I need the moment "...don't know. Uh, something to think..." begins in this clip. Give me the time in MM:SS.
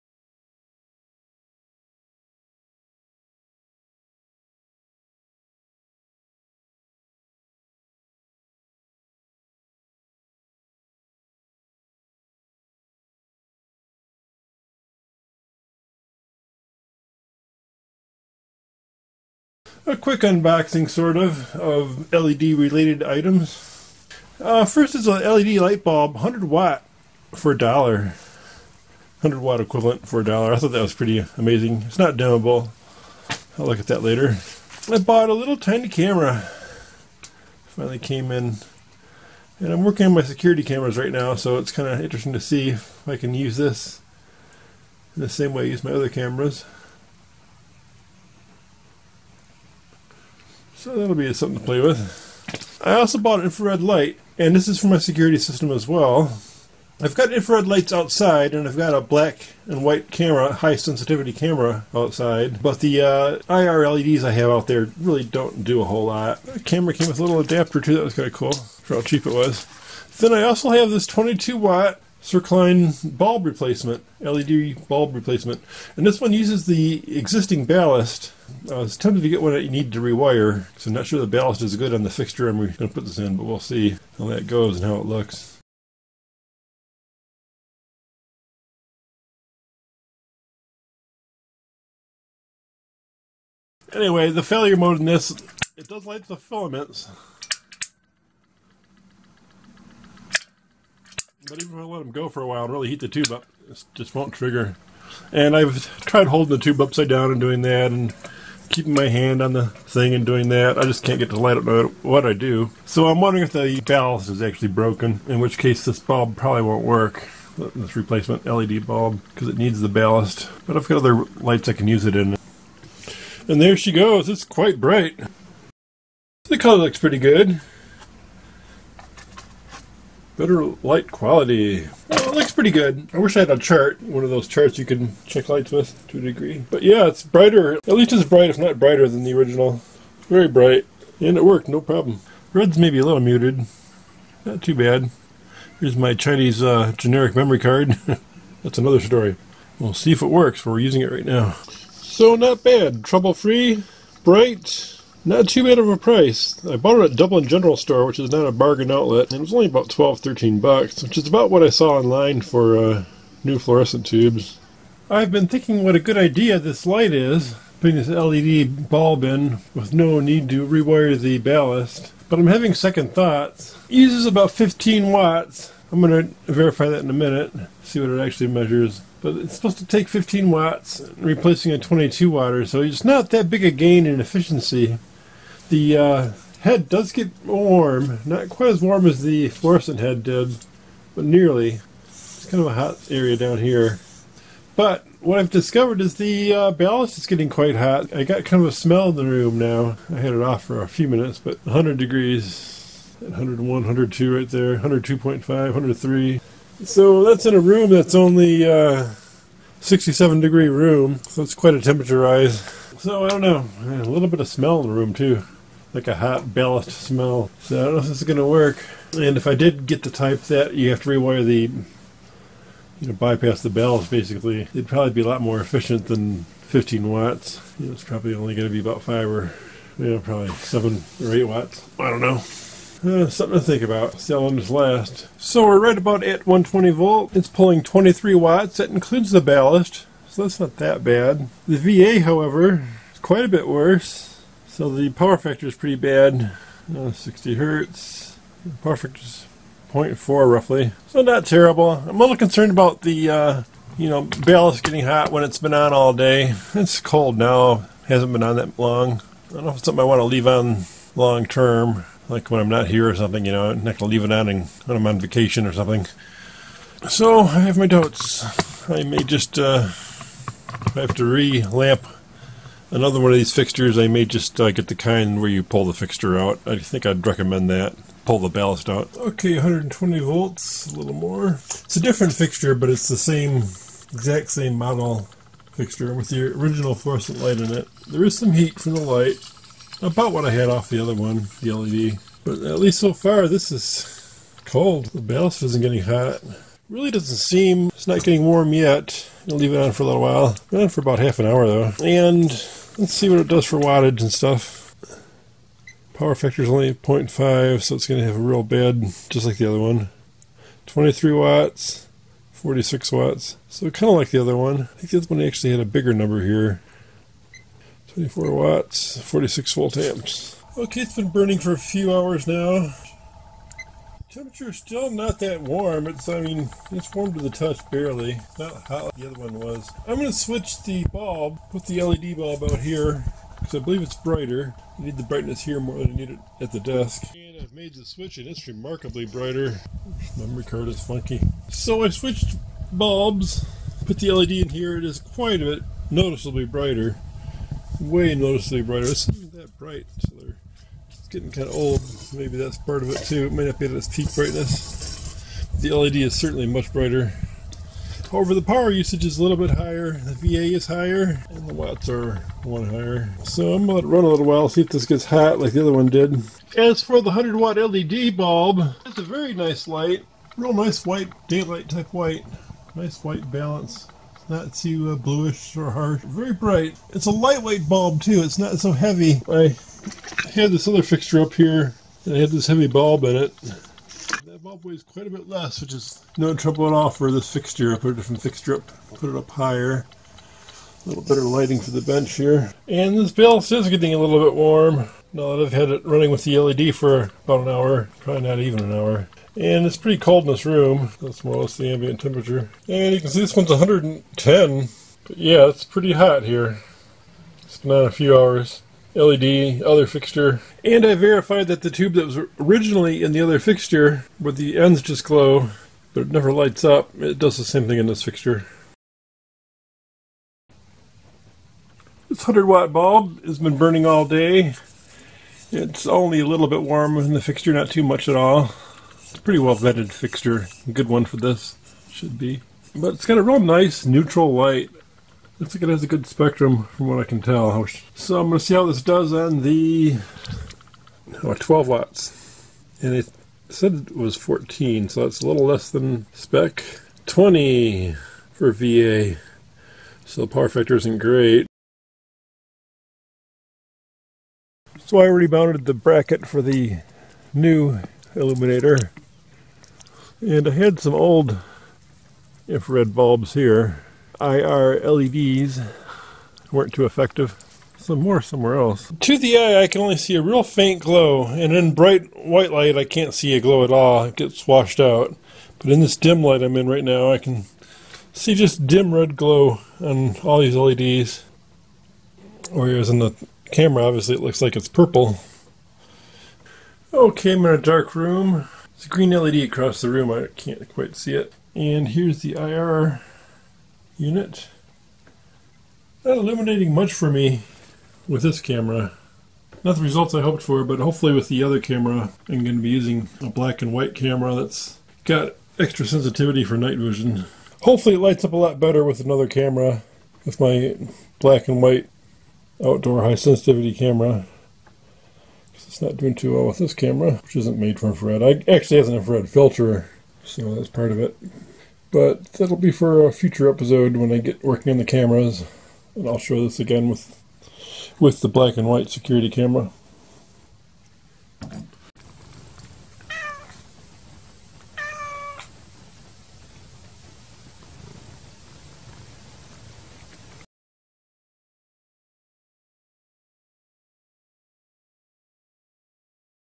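03:52.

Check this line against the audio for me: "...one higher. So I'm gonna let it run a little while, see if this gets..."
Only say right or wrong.
right.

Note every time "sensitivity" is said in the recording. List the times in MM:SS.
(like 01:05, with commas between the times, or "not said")
01:00, 08:26, 08:33.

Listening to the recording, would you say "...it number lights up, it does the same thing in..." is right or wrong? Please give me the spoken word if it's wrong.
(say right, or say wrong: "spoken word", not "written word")
wrong: "never", not "number".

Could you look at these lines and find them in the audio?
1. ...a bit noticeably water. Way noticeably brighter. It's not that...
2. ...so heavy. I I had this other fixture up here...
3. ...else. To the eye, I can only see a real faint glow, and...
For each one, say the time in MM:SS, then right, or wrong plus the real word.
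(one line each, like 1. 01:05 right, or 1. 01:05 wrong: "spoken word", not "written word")
1. 05:45 wrong: "brighter", not "water"
2. 06:18 right
3. 07:48 right.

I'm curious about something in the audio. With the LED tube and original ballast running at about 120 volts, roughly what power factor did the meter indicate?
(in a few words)
0.4.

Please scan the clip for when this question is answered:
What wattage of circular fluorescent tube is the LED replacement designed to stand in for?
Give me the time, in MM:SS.
01:11.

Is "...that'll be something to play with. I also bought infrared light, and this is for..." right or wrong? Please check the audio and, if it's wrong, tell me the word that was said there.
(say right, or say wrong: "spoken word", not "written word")
right.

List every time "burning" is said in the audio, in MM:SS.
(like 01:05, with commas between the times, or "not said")
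05:21, 07:03.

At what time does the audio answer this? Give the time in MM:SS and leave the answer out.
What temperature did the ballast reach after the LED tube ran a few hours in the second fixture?
06:43.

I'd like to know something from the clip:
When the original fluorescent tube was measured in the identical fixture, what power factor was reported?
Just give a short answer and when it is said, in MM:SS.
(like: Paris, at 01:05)
0.5, at 05:06.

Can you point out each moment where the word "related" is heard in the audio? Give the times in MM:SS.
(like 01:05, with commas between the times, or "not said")
00:22.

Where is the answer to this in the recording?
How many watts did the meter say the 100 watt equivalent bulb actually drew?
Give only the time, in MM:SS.
07:21.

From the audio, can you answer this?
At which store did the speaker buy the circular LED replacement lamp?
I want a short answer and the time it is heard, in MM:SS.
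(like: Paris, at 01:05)
Dublin General Store, at 02:37.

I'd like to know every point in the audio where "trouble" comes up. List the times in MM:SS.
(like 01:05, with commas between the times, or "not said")
02:33, 06:26.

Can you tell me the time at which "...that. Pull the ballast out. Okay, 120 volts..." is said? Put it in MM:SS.
04:37.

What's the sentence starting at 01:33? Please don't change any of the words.
Anyway, the failure mode in this, it does light the filaments.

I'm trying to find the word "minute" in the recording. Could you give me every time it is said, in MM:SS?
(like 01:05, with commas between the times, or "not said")
02:57, 03:21.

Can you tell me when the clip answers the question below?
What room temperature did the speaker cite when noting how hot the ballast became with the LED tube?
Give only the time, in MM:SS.
03:29.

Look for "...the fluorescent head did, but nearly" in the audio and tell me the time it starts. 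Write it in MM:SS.
03:09.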